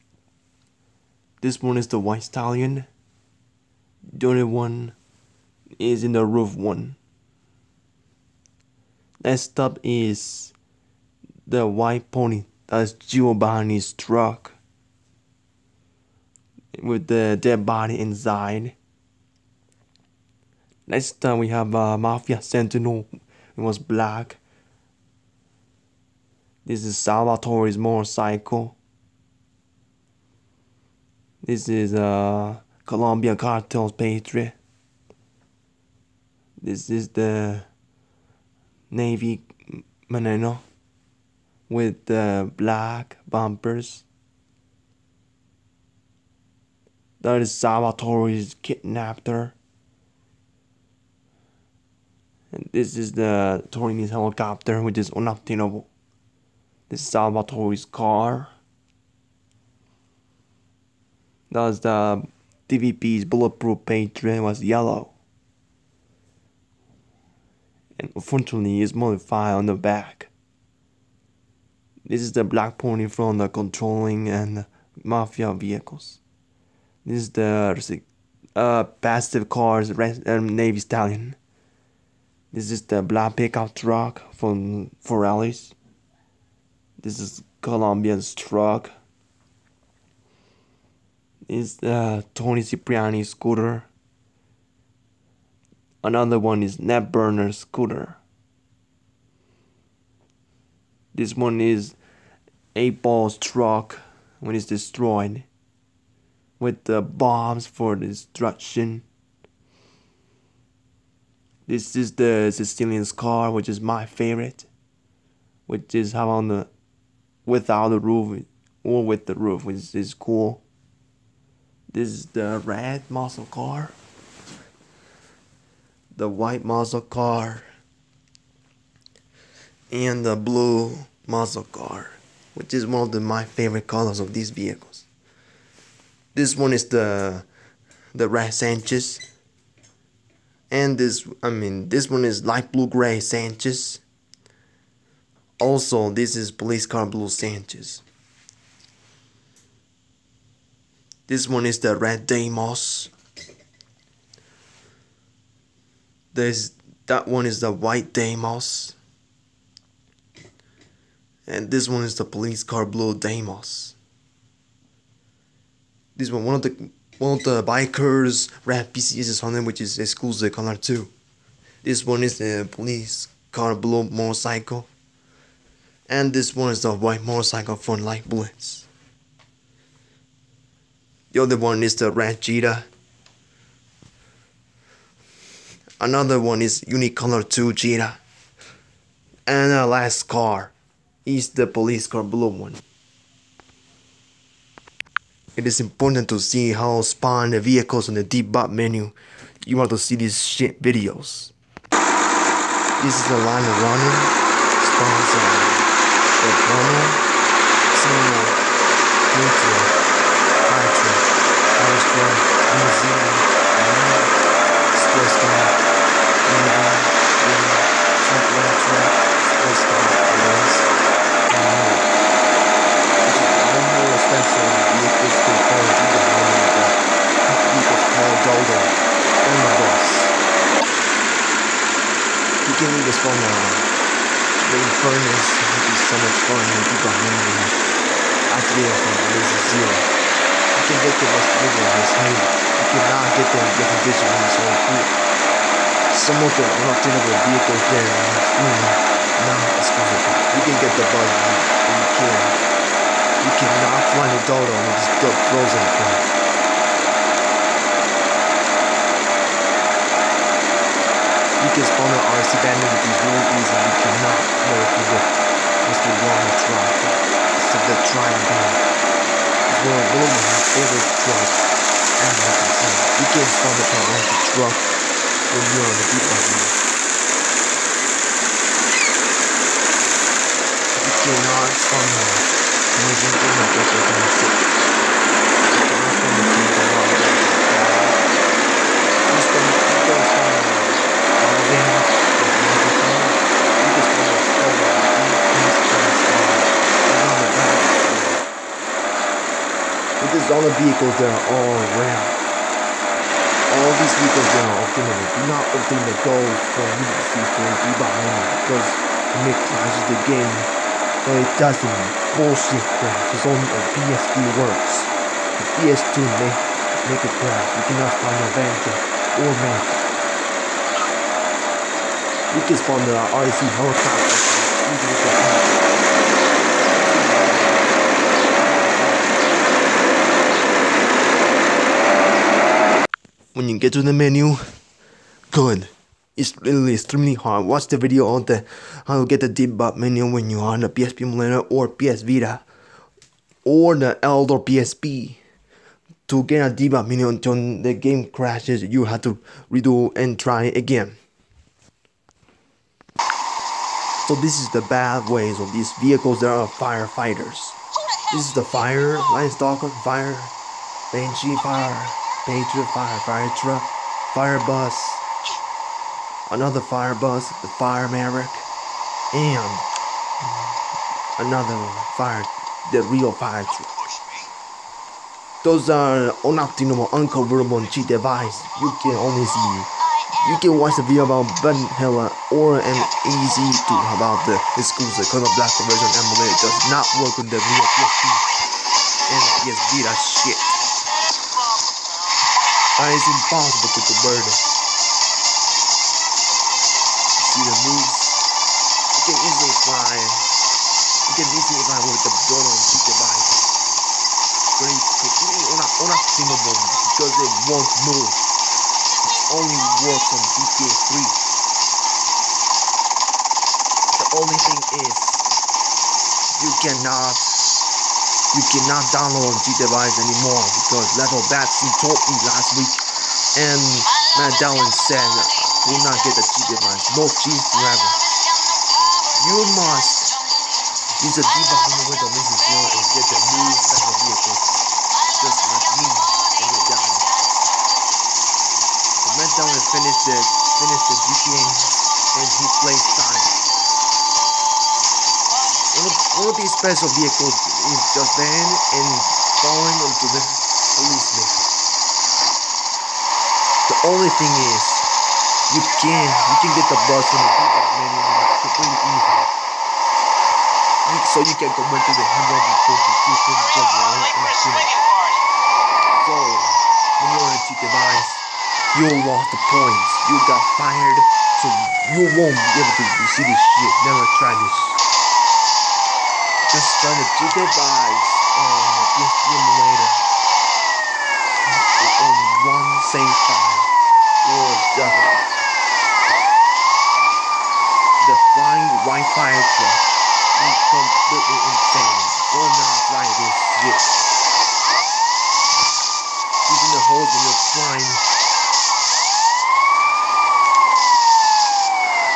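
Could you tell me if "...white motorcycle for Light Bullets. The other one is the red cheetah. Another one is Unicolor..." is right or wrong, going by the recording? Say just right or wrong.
right.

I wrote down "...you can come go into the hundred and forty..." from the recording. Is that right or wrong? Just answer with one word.
right.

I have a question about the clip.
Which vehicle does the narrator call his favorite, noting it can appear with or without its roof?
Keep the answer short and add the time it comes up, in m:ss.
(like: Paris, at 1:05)
The Sicilian car, at 1:52.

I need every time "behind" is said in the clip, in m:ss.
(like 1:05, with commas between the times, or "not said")
5:07.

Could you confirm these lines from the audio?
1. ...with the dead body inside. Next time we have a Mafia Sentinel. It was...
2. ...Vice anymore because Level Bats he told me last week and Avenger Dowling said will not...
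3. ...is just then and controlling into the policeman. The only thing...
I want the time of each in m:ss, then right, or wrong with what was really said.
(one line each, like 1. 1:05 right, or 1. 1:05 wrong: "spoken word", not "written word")
1. 0:16 right
2. 6:59 wrong: "Matt", not "Avenger"
3. 7:27 wrong: "falling", not "controlling".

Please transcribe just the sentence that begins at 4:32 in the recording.
And like I said, you can spawn a torrential truck when you're on the deep end.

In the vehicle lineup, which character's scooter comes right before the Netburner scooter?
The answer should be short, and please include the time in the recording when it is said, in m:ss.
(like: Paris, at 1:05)
Toni Cipriani, at 1:32.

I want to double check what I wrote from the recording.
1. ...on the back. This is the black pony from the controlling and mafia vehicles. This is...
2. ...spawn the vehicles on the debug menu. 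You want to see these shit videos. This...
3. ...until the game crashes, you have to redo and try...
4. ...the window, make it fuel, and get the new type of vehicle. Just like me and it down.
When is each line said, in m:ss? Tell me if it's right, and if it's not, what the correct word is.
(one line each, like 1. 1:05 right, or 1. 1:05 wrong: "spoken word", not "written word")
1. 1:09 right
2. 3:16 right
3. 5:47 right
4. 7:11 right.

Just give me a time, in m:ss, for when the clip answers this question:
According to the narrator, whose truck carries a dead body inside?
0:12.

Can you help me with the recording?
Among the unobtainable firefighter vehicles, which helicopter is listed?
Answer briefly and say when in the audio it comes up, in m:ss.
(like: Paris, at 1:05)
Fire Maverick, at 6:07.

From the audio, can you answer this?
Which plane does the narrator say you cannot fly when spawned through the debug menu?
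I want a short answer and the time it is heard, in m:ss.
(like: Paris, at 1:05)
The Dodo, at 4:14.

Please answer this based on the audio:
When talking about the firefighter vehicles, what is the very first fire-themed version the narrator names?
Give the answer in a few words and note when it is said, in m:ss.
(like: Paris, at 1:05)
Stalker fire, at 5:59.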